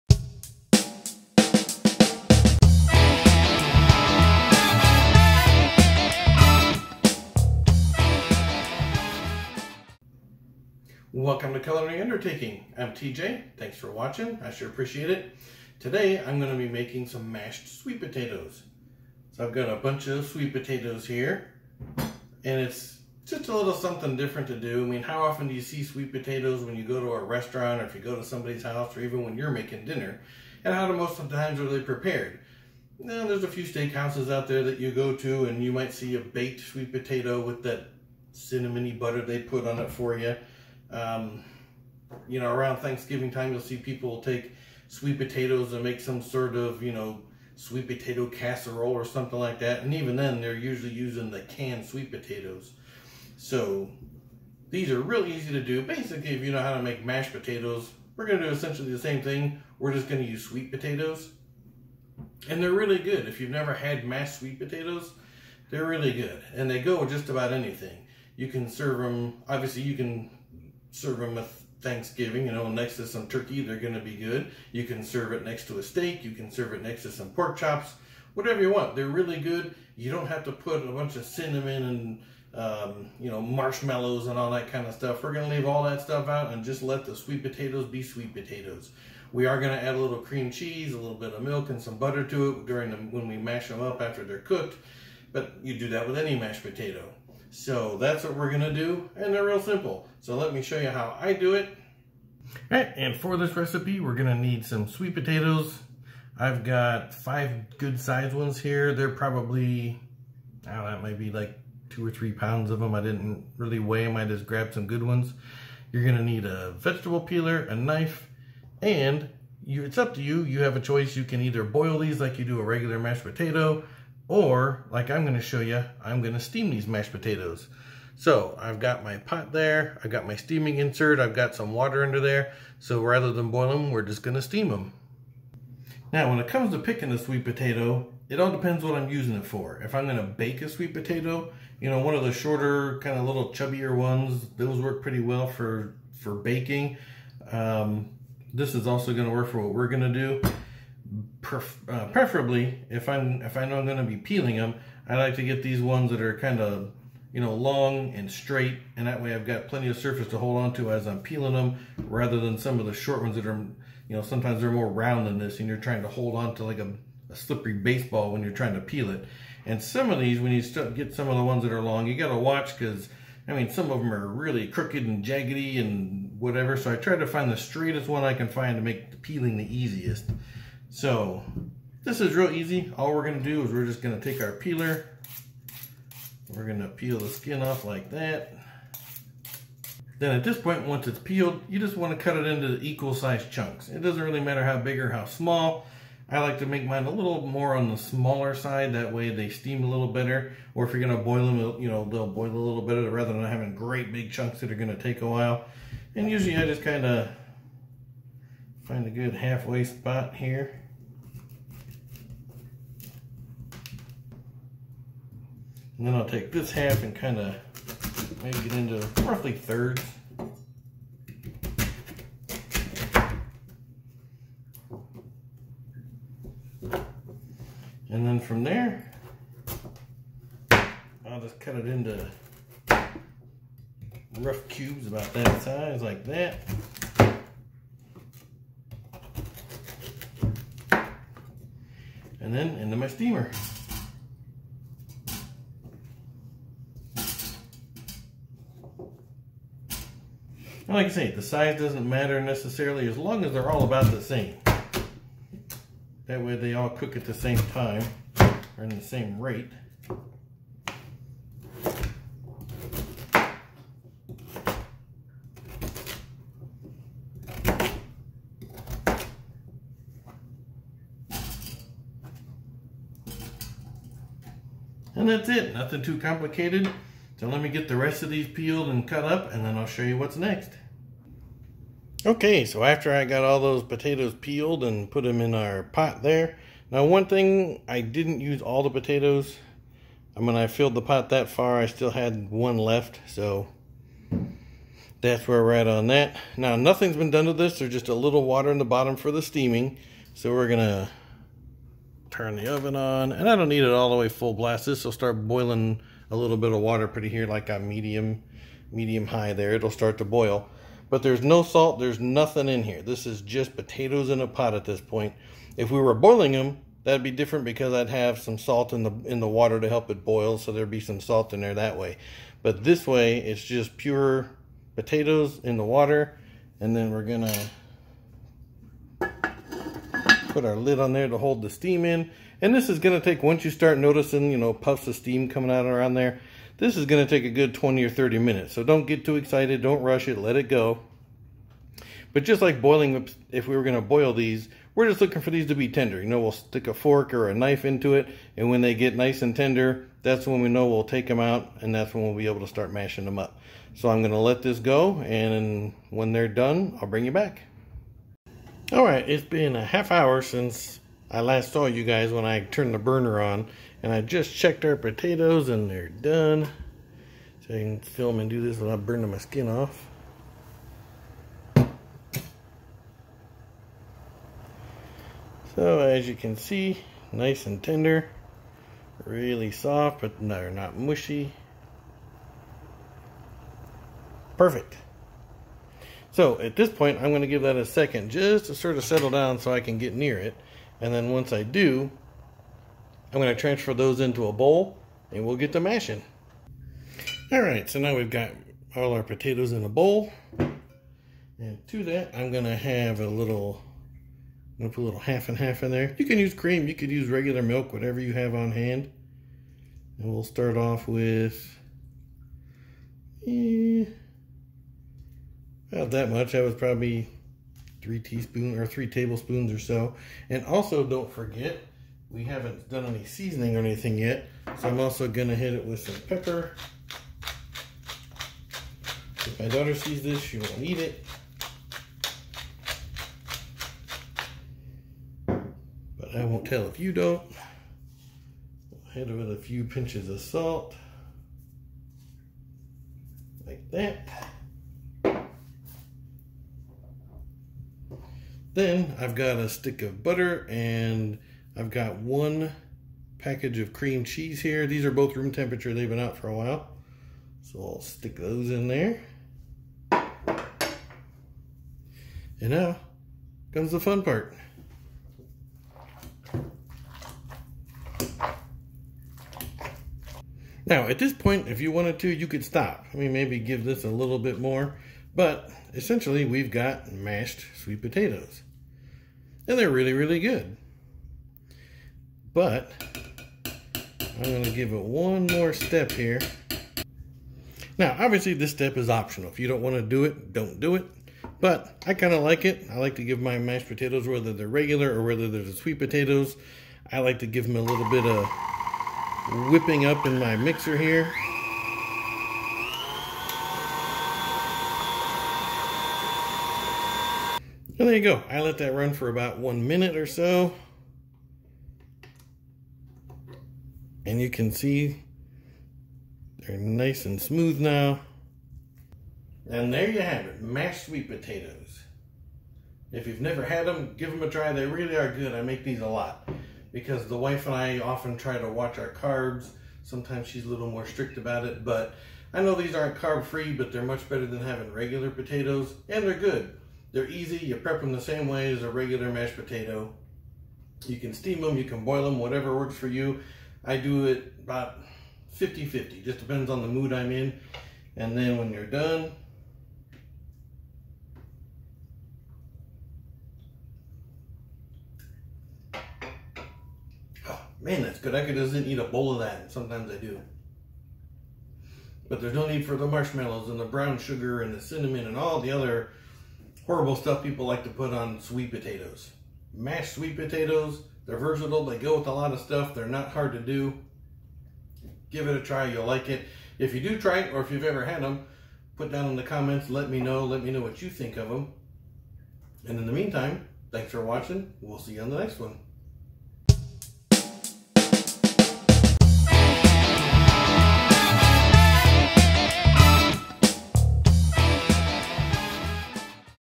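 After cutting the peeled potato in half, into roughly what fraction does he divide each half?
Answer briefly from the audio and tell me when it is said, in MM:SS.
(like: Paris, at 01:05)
thirds, at 03:39.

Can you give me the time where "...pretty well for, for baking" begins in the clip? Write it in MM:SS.
02:25.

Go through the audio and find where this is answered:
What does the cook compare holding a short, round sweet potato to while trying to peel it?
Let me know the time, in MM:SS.
02:47.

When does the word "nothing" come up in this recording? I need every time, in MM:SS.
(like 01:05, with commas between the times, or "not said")
04:35, 04:56, 05:12.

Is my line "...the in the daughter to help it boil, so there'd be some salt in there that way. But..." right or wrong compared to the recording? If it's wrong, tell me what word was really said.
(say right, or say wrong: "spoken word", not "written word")
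wrong: "water", not "daughter".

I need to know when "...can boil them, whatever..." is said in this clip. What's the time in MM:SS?
09:01.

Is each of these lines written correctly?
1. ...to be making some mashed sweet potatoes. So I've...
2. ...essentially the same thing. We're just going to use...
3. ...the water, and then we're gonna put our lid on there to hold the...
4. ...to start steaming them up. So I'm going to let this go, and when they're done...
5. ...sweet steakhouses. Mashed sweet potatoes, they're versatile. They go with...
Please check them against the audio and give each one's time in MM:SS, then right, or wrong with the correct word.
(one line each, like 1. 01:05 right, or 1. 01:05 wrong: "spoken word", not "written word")
1. 00:16 right
2. 00:58 right
3. 05:25 right
4. 05:52 wrong: "mashing", not "steaming"
5. 09:28 wrong: "potatoes", not "steakhouses".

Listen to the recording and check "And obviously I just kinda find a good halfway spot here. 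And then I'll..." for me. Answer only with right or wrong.
wrong.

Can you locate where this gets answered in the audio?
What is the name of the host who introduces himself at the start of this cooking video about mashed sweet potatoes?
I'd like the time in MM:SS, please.
00:12.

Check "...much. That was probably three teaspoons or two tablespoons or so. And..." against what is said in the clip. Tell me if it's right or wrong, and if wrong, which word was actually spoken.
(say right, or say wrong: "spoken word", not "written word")
wrong: "three", not "two".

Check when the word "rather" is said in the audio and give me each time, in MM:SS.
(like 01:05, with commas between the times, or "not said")
02:13, 02:42, 03:23.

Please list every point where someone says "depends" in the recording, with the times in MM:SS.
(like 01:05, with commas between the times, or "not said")
02:18, 09:06.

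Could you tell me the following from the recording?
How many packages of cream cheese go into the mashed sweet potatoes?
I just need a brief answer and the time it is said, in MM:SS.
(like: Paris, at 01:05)
1, at 07:32.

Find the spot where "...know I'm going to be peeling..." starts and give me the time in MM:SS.
02:33.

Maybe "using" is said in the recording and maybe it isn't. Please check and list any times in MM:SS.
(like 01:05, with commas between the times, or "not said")
00:50, 02:19.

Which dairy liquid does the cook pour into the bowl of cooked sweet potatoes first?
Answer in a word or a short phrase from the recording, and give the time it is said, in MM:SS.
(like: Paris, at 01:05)
half and half, at 06:45.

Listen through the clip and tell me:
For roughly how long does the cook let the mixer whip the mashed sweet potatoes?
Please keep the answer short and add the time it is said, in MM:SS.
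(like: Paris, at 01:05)
1 minute, at 08:29.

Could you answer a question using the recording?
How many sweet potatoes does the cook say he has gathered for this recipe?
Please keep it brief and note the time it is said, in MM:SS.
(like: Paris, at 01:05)
5, at 01:47.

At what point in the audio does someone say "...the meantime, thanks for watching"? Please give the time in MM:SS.
09:43.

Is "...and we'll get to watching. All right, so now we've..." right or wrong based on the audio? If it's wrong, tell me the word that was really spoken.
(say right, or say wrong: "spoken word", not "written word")
wrong: "mashing", not "watching".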